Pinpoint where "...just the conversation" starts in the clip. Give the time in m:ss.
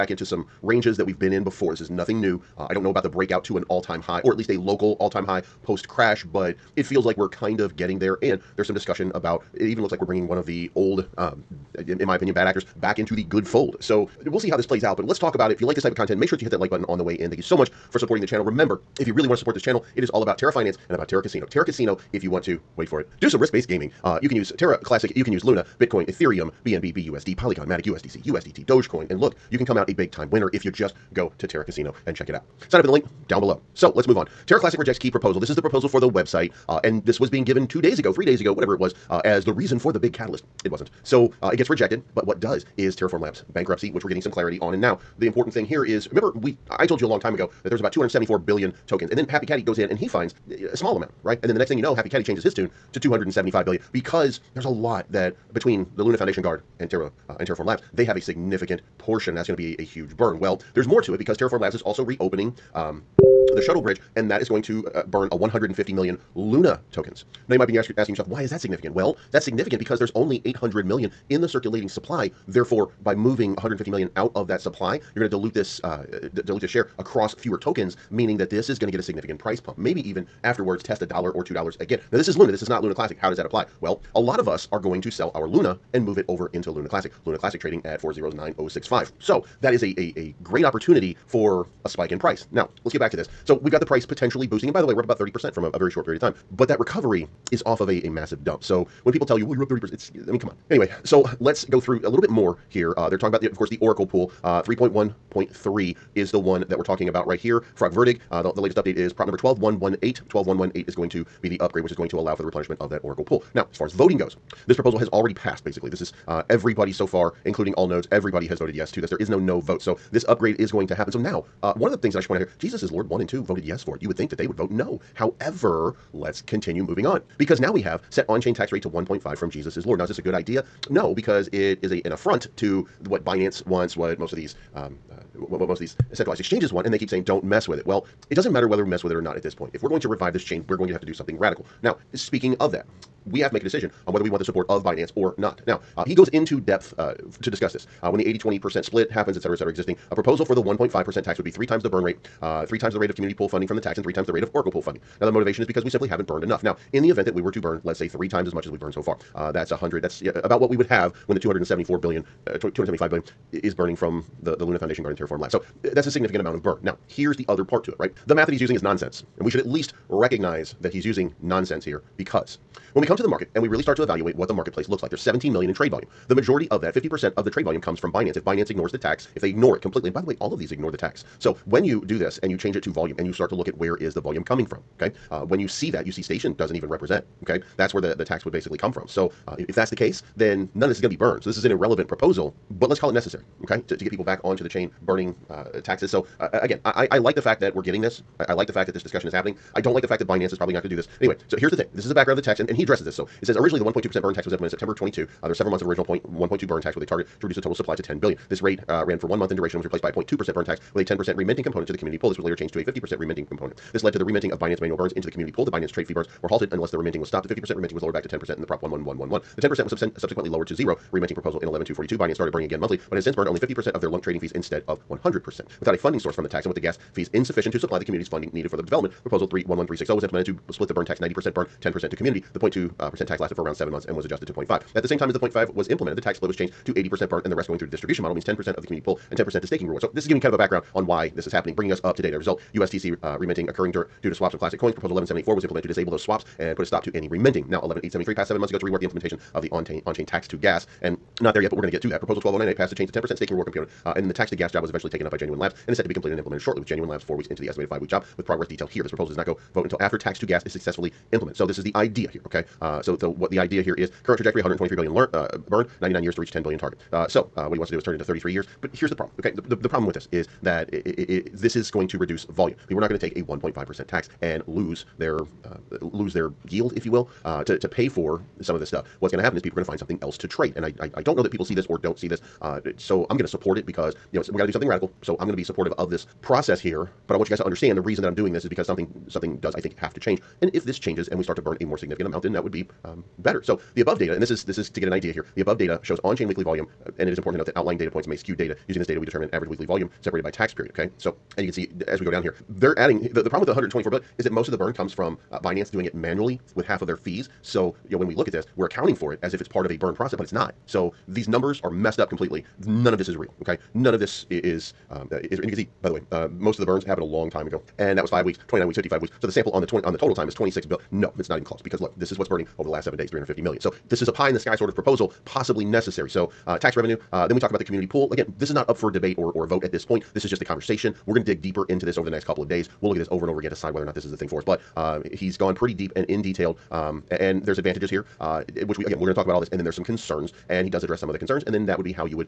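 5:30.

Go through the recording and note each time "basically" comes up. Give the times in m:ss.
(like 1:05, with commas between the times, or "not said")
1:55, 3:08.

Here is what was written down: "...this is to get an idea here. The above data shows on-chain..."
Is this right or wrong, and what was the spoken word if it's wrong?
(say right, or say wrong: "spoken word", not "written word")
right.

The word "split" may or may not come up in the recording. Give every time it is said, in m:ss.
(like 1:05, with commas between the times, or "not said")
2:28, 3:50, 3:56.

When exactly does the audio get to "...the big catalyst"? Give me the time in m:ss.
0:39.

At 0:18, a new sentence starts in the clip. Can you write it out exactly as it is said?
Remember, if you really want to support this channel, it is all about Terra Finance and about Terra Casino.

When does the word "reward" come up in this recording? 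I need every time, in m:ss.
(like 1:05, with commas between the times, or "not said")
3:59, 4:13.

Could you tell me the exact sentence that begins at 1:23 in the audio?
Well, a lot of us are going to sell our Luna and move it over into Luna Classic.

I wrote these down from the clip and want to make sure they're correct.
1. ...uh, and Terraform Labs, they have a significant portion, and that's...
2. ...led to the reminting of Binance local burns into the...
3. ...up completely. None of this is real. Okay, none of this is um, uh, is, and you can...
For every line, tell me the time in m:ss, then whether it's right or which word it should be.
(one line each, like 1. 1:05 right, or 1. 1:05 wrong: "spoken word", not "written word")
1. 0:57 right
2. 3:34 wrong: "manual", not "local"
3. 5:12 right.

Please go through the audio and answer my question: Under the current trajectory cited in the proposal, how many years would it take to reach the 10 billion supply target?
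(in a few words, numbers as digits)
99 years.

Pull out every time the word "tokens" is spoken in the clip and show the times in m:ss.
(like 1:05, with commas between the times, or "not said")
0:48, 1:06, 1:17.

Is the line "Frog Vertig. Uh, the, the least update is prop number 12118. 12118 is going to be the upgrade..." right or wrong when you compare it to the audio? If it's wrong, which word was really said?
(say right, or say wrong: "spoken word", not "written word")
wrong: "latest", not "least".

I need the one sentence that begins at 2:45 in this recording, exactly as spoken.
So that's a significant amount of burn.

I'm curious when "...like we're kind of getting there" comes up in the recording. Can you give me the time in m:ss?
0:07.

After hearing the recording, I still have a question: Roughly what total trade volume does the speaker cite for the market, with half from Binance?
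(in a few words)
17 million.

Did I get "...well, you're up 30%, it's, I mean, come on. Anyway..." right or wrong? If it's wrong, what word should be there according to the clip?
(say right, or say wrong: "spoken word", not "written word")
right.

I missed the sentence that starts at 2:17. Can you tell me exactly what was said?
Well, it doesn't matter whether we mess with it or not at this point.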